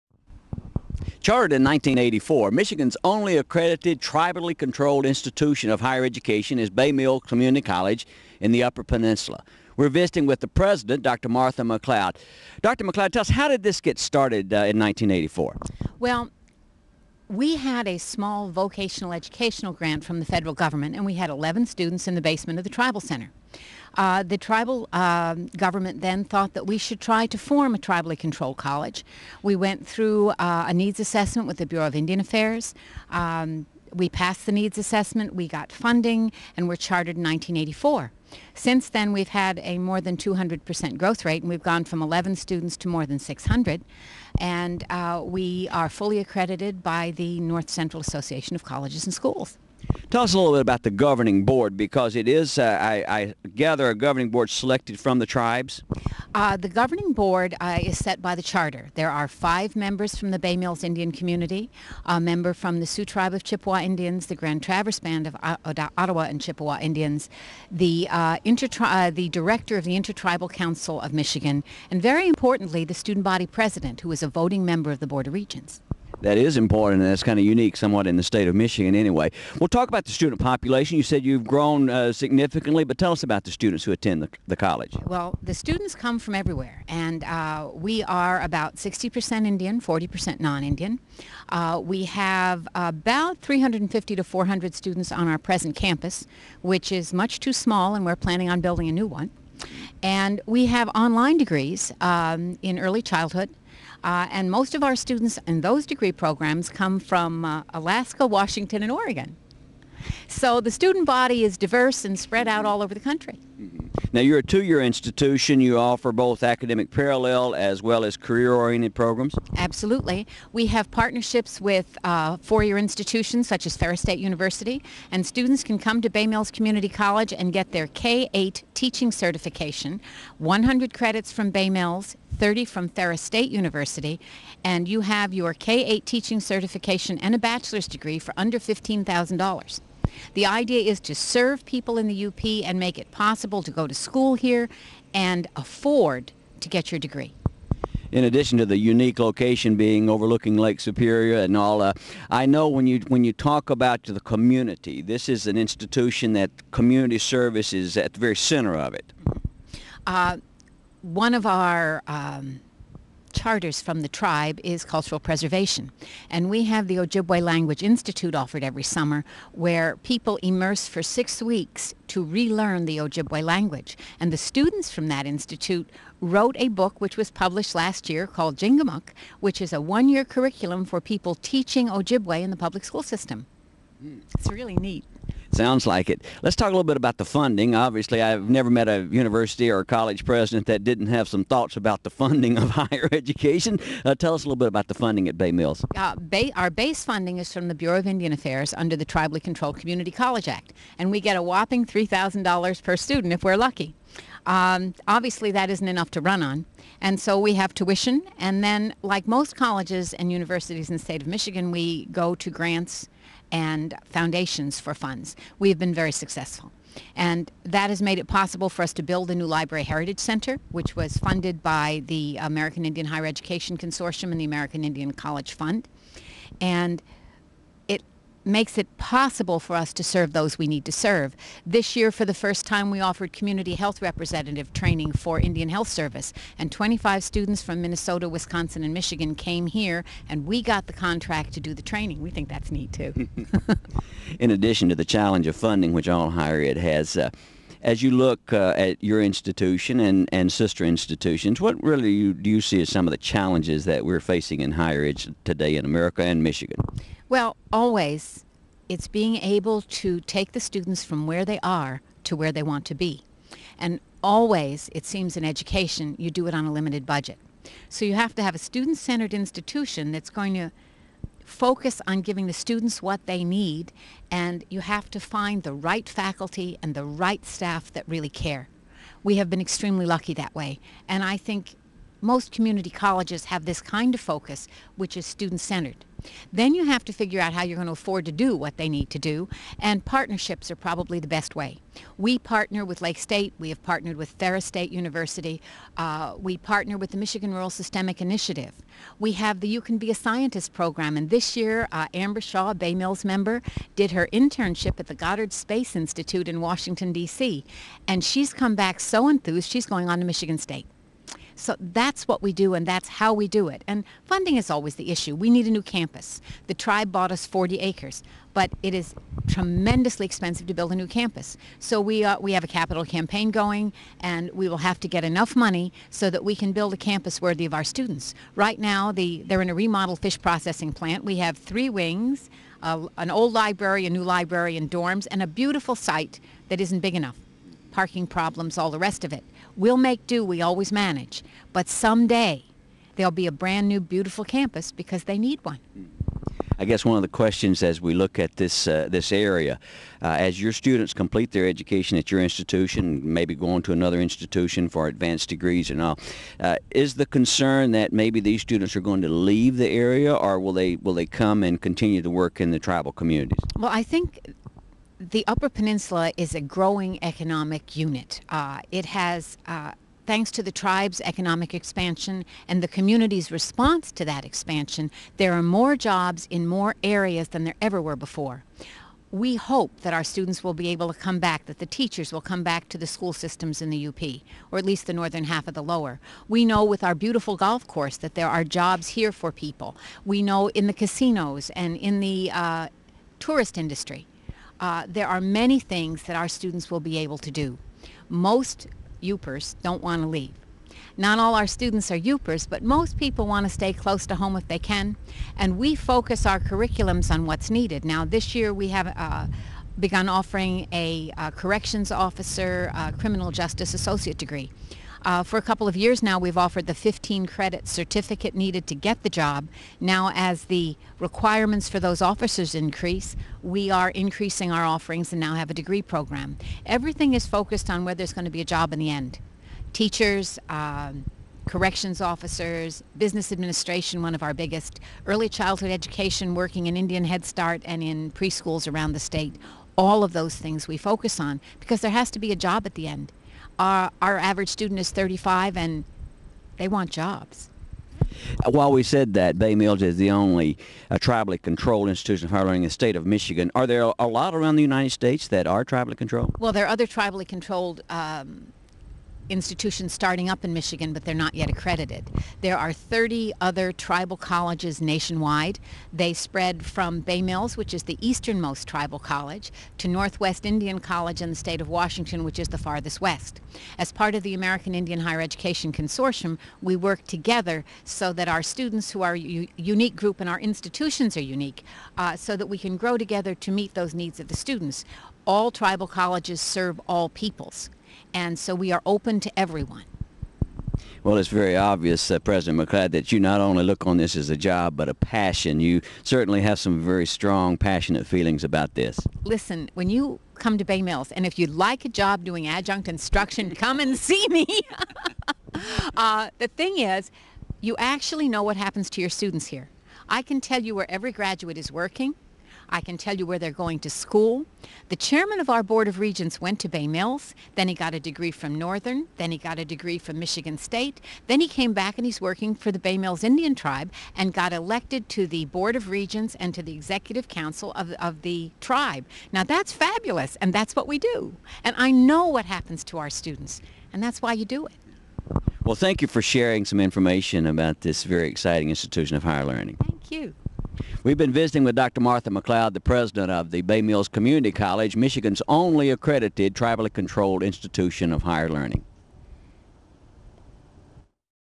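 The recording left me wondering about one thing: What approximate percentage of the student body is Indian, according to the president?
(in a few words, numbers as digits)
60%.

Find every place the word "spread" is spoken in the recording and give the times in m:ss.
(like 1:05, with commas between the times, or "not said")
1:52, 7:46.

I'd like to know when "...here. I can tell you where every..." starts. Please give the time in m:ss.
8:29.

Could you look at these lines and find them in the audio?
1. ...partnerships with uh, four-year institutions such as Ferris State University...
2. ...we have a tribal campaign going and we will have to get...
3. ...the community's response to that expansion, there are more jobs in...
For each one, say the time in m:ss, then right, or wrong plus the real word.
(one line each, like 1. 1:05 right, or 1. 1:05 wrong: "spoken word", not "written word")
1. 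2:00 right
2. 5:22 wrong: "capital", not "tribal"
3. 6:12 right.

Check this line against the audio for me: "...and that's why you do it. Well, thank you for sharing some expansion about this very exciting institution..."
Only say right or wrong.
wrong.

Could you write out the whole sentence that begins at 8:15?
You certainly have some very strong, passionate feelings about this.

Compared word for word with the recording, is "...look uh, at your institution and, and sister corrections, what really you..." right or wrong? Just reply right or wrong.
wrong.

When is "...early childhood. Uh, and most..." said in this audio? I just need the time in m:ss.
1:42.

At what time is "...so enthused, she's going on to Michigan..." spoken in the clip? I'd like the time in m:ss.
5:08.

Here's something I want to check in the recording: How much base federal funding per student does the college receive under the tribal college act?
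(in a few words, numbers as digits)
$3,000.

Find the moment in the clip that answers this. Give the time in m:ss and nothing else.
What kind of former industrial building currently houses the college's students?
5:30.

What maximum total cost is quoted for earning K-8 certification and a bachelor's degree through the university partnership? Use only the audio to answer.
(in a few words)
$15,000.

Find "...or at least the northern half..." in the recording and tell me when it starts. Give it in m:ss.
6:24.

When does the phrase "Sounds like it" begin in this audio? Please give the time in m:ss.
3:05.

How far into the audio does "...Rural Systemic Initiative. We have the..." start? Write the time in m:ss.
4:57.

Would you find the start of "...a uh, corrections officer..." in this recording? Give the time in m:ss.
6:50.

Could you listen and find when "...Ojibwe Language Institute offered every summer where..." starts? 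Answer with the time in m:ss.
2:46.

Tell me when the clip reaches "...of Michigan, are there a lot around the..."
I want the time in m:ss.
7:33.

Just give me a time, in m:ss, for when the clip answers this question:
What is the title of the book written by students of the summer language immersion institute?
2:58.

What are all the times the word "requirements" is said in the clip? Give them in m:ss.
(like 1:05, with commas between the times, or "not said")
7:01.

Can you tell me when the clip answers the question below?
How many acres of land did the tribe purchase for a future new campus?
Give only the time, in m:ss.
5:17.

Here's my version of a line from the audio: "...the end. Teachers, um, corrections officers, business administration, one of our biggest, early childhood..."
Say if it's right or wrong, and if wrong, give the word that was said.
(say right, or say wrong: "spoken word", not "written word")
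right.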